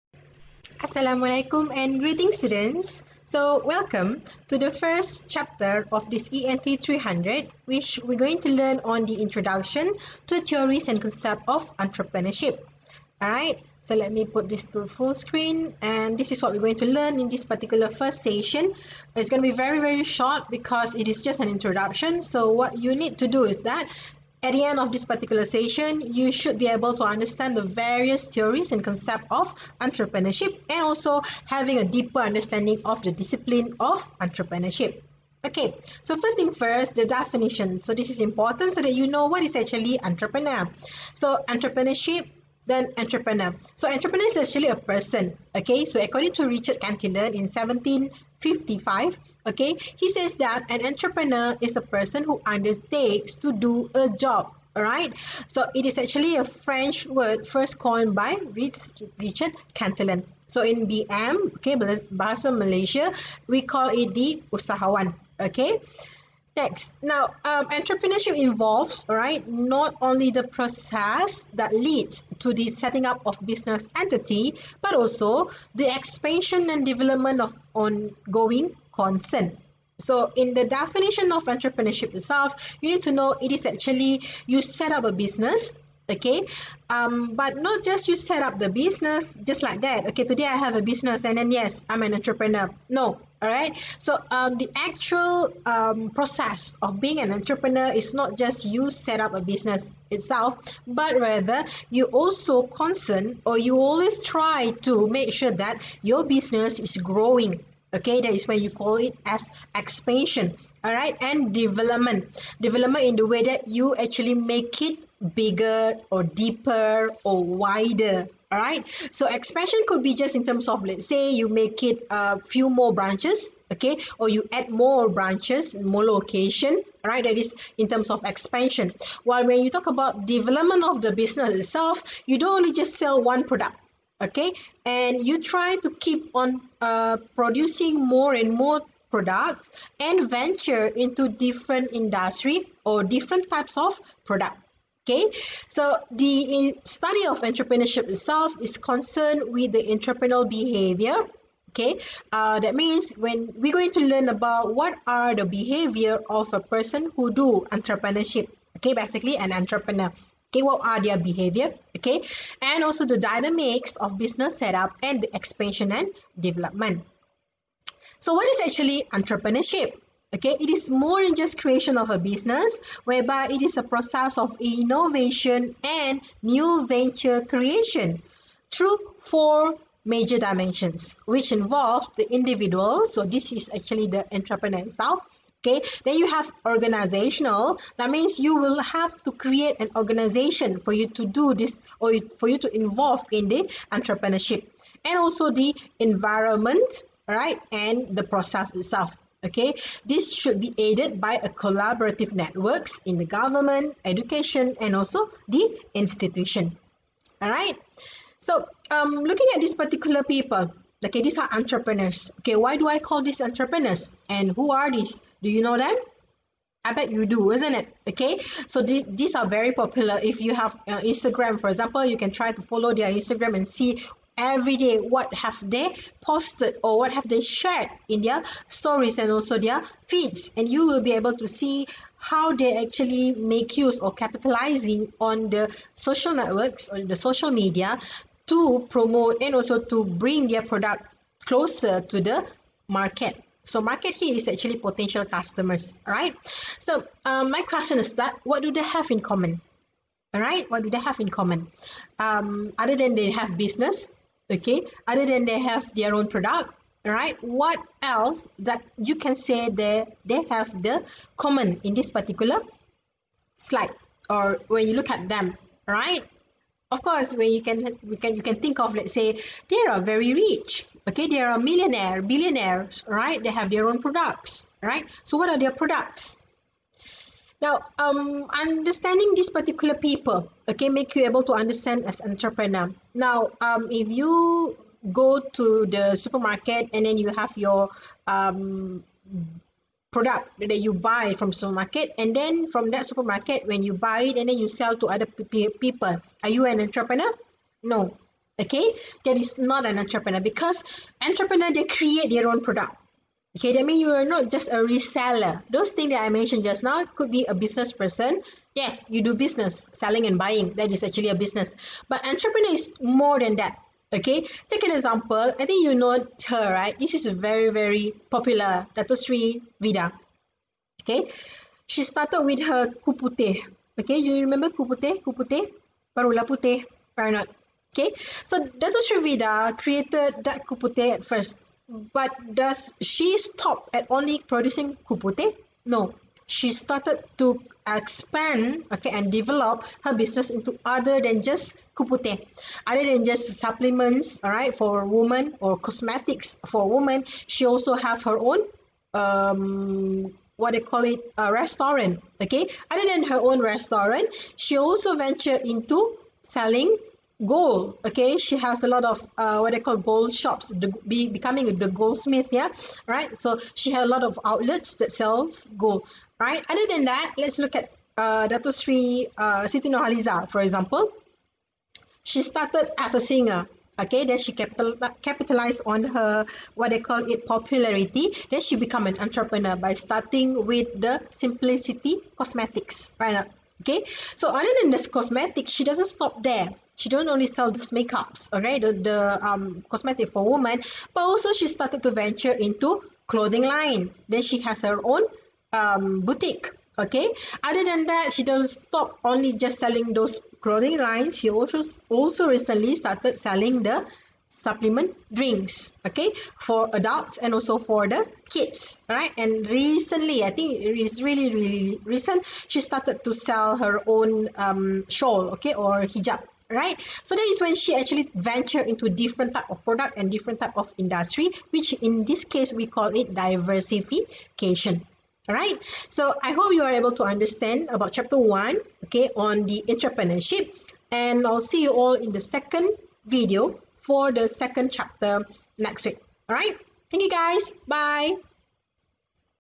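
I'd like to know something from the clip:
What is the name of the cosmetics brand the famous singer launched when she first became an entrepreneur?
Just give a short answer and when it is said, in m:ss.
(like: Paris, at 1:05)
Simplicity, at 6:21.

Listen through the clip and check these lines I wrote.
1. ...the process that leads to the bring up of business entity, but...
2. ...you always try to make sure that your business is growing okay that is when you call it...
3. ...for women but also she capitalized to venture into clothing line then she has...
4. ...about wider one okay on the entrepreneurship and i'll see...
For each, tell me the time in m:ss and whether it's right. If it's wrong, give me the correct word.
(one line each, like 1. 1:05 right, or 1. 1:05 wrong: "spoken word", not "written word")
1. 1:10 wrong: "setting", not "bring"
2. 1:43 right
3. 6:30 wrong: "started", not "capitalized"
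4. 7:07 wrong: "chapter", not "wider".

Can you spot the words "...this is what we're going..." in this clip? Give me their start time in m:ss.
0:16.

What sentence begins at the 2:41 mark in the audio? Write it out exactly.
Okay, and also the dynamics of business setup and expansion and development.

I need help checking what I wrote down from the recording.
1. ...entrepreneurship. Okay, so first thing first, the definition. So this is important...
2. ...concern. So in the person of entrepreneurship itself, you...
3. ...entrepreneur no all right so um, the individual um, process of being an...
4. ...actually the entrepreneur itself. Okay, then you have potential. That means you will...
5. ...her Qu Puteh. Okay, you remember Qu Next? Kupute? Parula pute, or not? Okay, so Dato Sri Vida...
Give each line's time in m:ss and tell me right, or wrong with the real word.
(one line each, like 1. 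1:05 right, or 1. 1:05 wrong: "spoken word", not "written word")
1. 0:34 right
2. 1:18 wrong: "definition", not "person"
3. 1:32 wrong: "actual", not "individual"
4. 3:03 wrong: "organizational", not "potential"
5. 5:22 wrong: "Puteh", not "Next".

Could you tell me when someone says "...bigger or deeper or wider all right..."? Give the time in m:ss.
1:55.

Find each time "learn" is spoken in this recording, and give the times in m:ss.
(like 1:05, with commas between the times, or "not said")
0:08, 0:16, 2:34.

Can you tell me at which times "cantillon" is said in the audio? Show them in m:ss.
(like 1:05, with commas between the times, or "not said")
0:46, 0:59.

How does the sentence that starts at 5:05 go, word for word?
Those things that I mentioned just now could be a business person.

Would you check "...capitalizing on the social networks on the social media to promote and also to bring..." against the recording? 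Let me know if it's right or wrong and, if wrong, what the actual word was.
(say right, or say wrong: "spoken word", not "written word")
right.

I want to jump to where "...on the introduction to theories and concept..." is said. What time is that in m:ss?
0:08.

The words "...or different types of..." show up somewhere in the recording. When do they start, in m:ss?
2:22.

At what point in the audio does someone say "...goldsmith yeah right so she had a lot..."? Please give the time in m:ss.
6:01.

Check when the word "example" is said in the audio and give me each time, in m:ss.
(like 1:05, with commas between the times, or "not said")
3:41, 5:14, 6:10.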